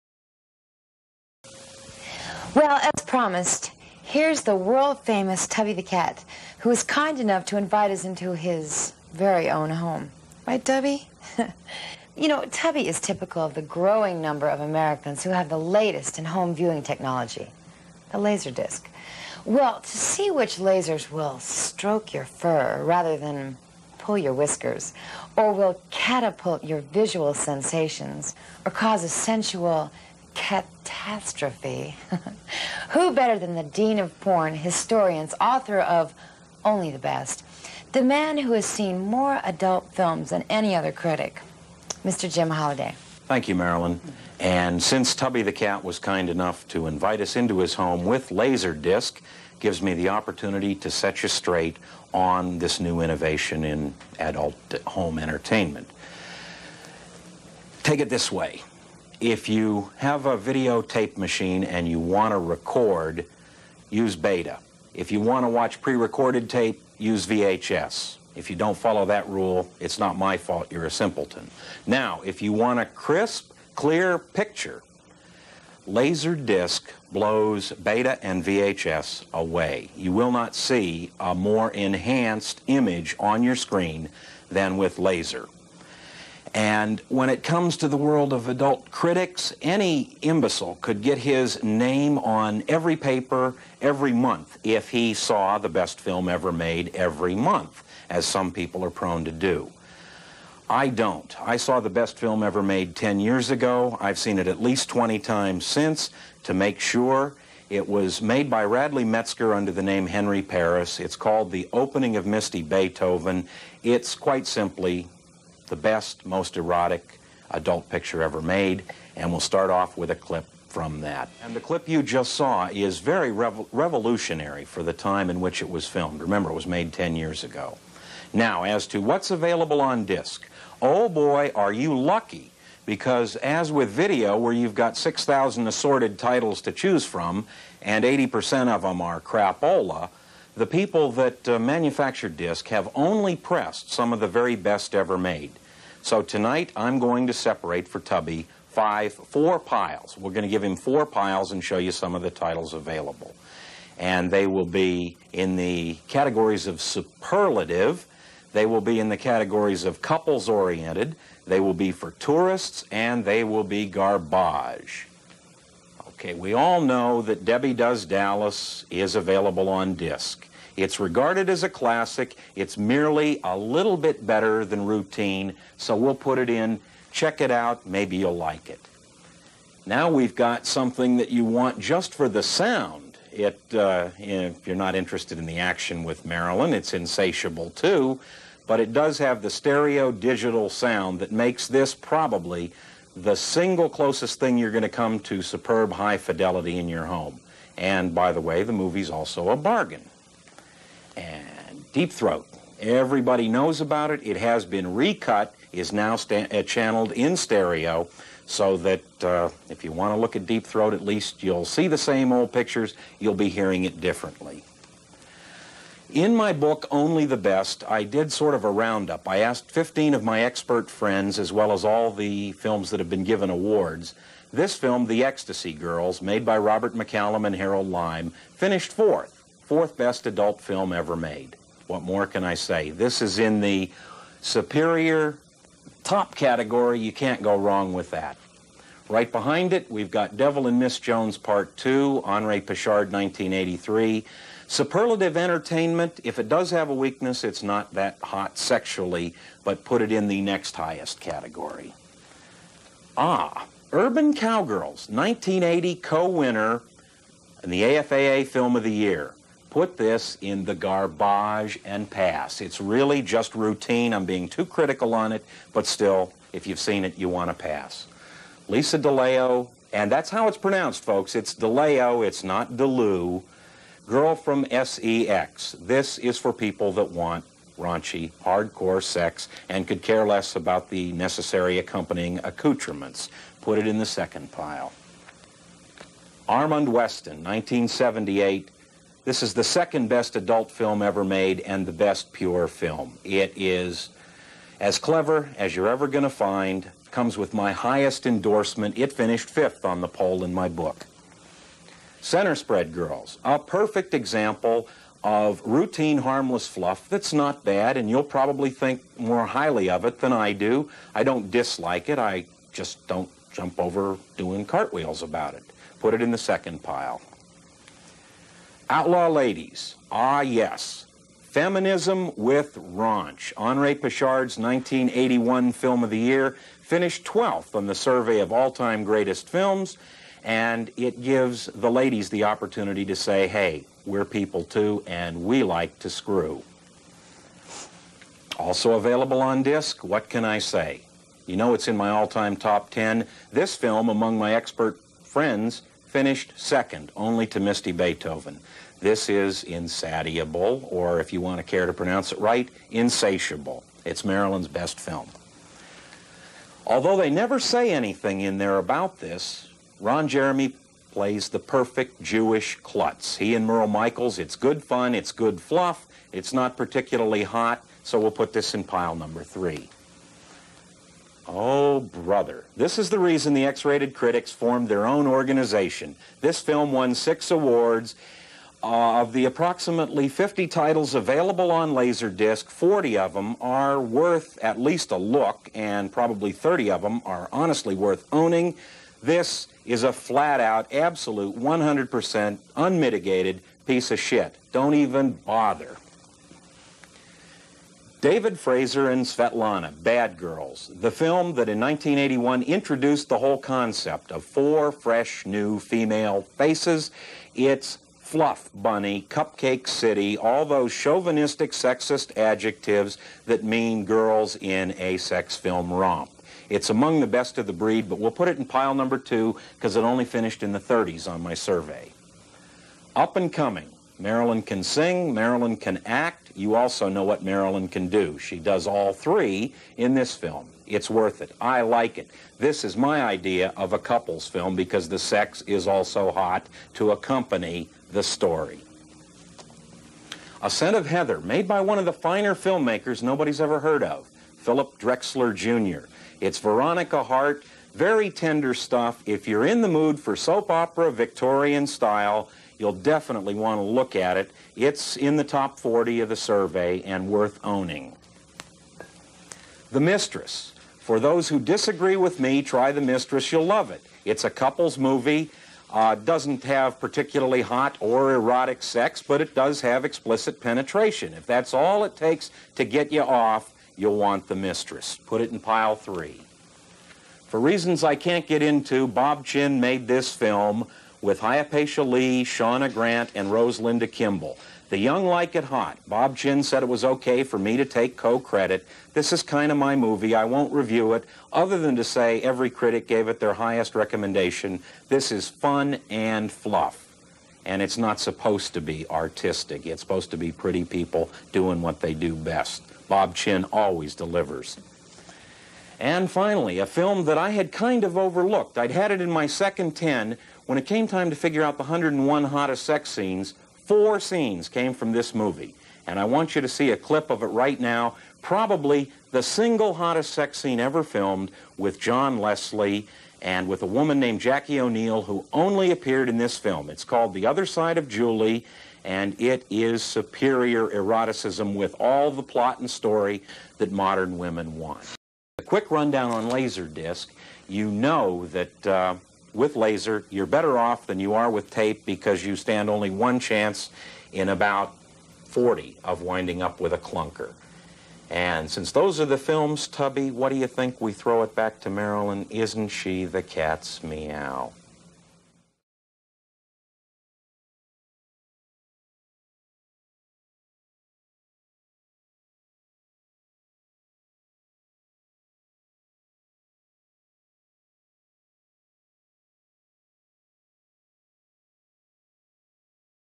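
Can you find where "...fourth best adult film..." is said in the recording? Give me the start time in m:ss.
3:49.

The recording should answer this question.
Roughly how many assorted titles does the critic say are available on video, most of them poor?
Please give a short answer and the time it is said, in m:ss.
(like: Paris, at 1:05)
6,000, at 2:14.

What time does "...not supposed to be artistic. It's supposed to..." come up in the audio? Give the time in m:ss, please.
8:17.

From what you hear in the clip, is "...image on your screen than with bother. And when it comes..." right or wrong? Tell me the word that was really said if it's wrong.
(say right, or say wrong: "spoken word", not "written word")
wrong: "laser", not "bother".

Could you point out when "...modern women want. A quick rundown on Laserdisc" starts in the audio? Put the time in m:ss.
8:53.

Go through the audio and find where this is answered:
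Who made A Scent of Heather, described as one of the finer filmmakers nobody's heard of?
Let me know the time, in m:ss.
7:24.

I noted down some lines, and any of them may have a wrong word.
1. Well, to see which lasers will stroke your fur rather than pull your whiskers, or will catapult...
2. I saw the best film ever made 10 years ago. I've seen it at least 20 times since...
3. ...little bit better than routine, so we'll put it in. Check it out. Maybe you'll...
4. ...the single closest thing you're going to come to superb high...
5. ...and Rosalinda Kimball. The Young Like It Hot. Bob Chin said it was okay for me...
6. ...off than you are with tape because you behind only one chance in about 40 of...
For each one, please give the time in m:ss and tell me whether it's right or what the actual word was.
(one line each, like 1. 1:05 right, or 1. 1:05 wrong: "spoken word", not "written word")
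1. 0:19 right
2. 1:41 right
3. 2:53 right
4. 3:13 right
5. 8:03 right
6. 9:00 wrong: "stand", not "behind".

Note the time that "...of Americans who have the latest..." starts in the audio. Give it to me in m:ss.
0:14.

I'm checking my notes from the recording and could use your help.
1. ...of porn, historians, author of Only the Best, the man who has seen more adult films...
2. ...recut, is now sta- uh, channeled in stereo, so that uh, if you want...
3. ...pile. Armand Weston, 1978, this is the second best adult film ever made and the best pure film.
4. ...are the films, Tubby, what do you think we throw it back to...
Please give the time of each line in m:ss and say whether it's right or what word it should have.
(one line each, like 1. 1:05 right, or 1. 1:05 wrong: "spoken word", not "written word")
1. 0:33 right
2. 3:24 right
3. 4:44 right
4. 9:09 right.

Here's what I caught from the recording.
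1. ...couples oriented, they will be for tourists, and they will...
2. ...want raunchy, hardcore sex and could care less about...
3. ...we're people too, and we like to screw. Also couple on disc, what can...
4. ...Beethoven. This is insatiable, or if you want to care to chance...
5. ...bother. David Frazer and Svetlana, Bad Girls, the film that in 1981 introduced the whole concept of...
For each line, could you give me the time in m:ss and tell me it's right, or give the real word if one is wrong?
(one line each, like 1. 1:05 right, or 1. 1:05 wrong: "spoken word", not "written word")
1. 2:40 right
2. 4:37 right
3. 5:34 wrong: "available", not "couple"
4. 5:47 wrong: "pronounce", not "chance"
5. 6:35 right.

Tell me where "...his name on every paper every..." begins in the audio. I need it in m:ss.
1:31.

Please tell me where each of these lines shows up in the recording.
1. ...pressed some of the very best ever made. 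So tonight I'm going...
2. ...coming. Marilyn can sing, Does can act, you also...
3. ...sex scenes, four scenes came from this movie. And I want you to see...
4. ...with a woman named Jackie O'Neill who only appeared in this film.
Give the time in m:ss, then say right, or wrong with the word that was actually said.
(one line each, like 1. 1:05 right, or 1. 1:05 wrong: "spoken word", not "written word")
1. 2:23 right
2. 7:03 wrong: "Marilyn", not "Does"
3. 8:32 right
4. 8:43 right.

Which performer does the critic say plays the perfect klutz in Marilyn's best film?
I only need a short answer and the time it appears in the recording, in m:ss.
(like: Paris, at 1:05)
Ron Jeremy, at 6:00.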